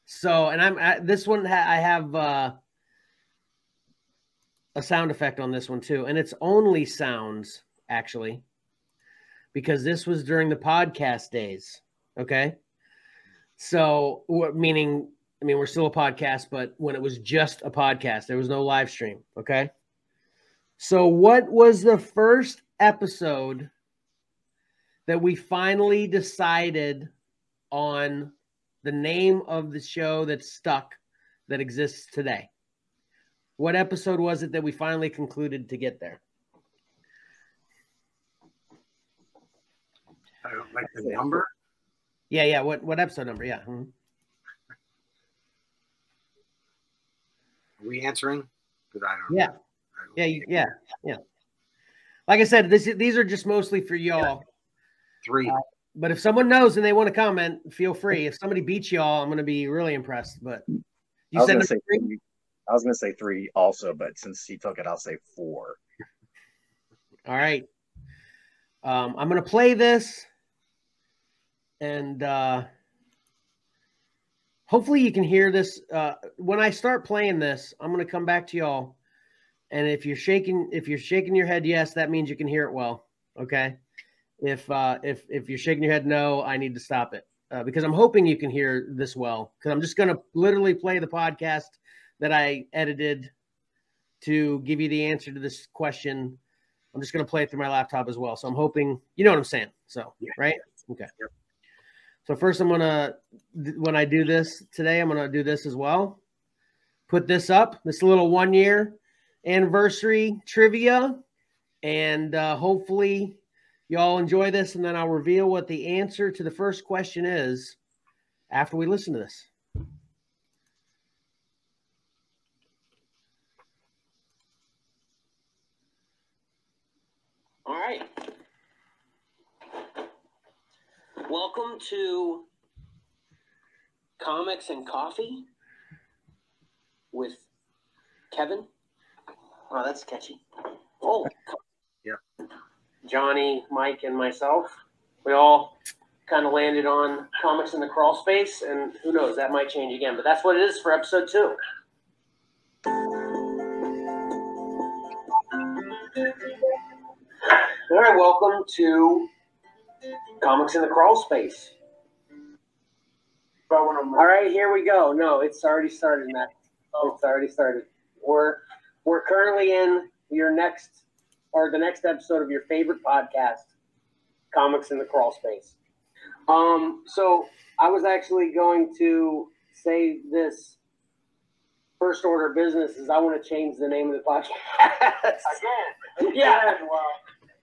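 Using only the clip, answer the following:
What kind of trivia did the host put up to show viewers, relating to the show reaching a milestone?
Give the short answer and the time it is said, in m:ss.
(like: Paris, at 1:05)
one year anniversary trivia, at 1:48.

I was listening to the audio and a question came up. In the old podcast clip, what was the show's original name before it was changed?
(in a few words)
Comics and Coffee with Kevin.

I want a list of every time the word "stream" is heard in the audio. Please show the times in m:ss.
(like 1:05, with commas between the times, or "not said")
0:18.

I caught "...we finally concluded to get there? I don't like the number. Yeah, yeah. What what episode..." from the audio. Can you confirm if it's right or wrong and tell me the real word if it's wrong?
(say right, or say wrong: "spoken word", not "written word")
right.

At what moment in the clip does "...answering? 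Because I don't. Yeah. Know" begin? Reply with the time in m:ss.
0:48.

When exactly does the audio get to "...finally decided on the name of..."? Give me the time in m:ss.
0:25.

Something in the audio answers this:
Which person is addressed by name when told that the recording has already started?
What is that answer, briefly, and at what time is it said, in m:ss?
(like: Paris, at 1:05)
Matt, at 2:46.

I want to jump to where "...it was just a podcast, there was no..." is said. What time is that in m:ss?
0:16.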